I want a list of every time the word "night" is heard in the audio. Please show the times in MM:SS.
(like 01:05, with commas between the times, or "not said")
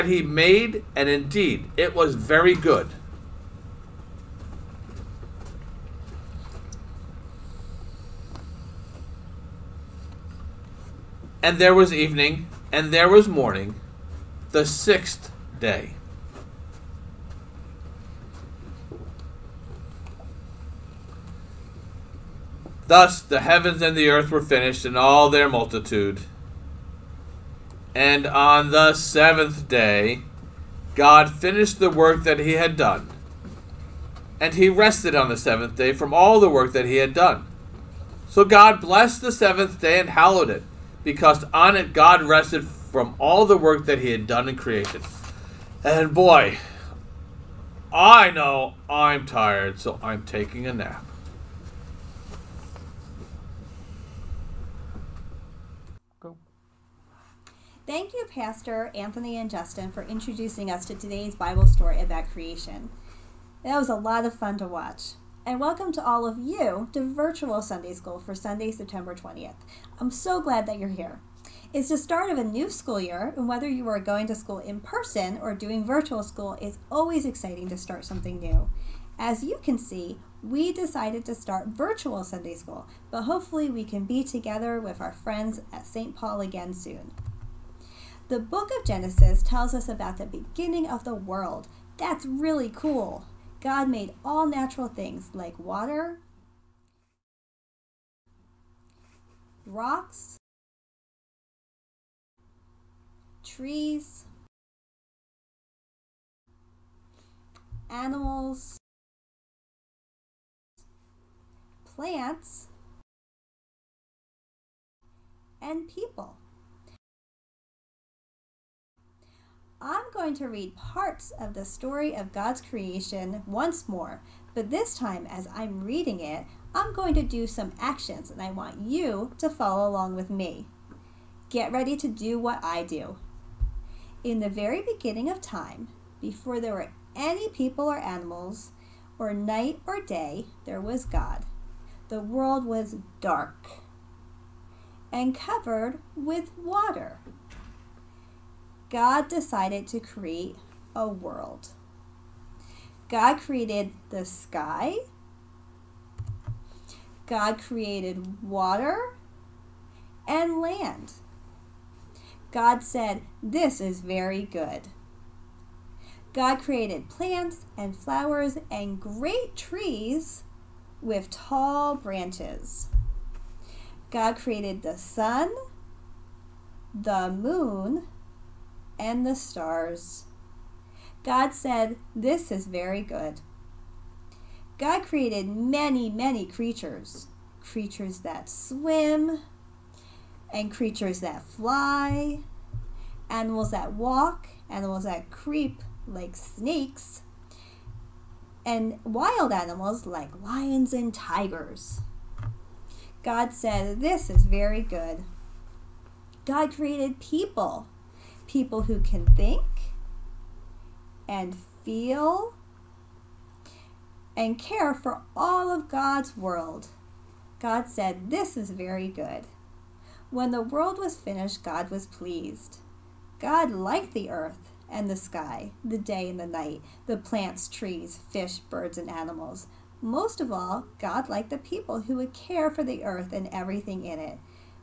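02:19, 03:46.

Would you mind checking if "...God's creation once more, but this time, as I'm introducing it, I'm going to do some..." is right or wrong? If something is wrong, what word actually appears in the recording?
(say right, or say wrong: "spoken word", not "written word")
wrong: "reading", not "introducing".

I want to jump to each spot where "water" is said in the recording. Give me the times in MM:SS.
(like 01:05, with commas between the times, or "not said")
01:35, 02:26, 02:38.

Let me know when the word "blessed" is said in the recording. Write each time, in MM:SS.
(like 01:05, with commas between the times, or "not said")
00:38.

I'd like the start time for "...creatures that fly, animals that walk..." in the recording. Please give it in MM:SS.
03:10.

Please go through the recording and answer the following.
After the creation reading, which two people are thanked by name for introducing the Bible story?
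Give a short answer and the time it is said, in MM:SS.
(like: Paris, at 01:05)
Pastor Anthony and Justin, at 00:58.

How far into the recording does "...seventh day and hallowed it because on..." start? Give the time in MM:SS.
00:39.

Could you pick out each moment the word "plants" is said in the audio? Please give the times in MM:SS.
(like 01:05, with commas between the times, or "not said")
01:51, 02:47, 03:47.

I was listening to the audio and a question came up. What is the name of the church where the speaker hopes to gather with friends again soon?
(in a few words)
St. Paul.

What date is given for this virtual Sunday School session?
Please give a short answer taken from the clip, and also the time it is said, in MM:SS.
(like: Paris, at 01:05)
Sunday, September 20th, at 01:08.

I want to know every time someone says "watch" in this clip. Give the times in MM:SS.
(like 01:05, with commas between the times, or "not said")
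01:04.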